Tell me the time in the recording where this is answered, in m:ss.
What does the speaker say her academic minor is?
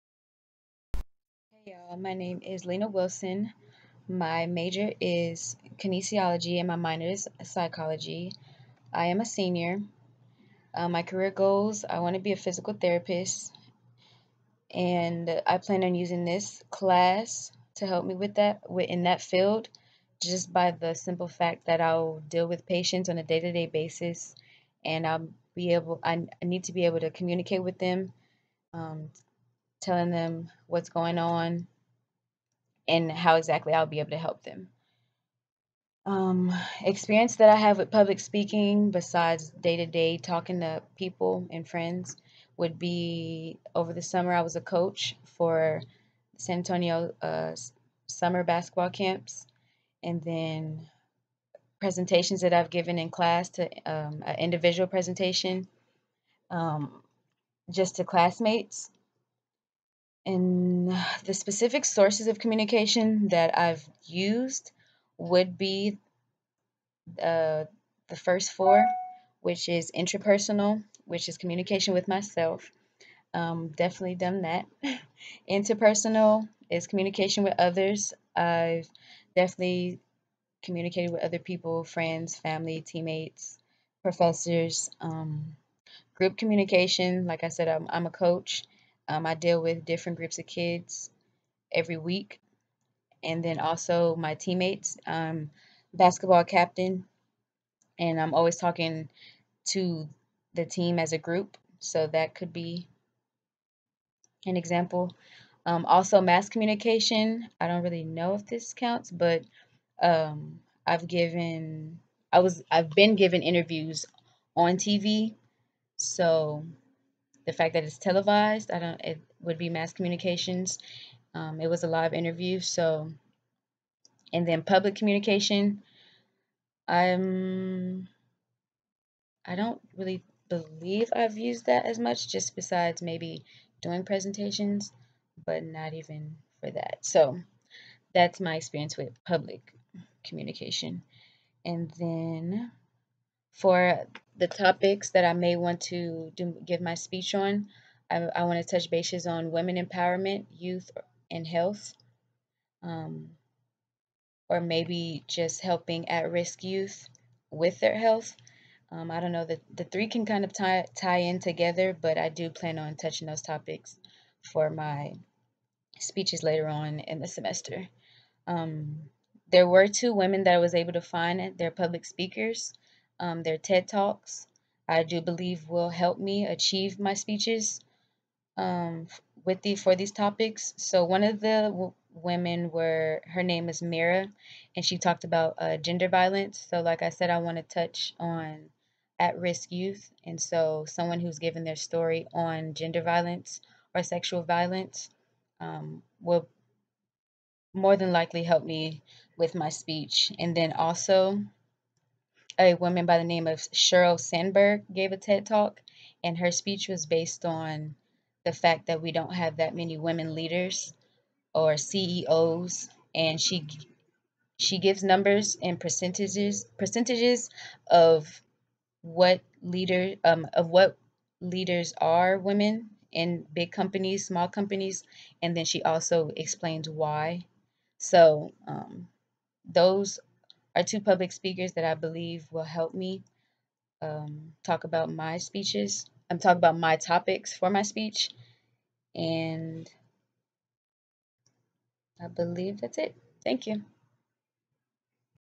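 0:07.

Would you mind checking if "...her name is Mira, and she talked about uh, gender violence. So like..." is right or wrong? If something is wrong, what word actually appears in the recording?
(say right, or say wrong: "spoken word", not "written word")
right.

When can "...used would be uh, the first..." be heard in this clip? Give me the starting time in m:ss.
1:04.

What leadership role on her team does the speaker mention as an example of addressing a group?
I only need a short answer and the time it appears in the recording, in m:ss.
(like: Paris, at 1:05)
Basketball captain, at 1:35.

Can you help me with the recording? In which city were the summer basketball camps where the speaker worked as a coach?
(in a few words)
San Antonio.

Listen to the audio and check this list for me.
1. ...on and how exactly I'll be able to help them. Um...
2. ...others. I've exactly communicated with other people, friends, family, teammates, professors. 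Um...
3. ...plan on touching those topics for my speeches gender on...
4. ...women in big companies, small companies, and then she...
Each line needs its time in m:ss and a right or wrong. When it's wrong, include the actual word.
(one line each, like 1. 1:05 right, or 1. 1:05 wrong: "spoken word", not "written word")
1. 0:31 right
2. 1:17 wrong: "definitely", not "exactly"
3. 2:42 wrong: "later", not "gender"
4. 3:42 right.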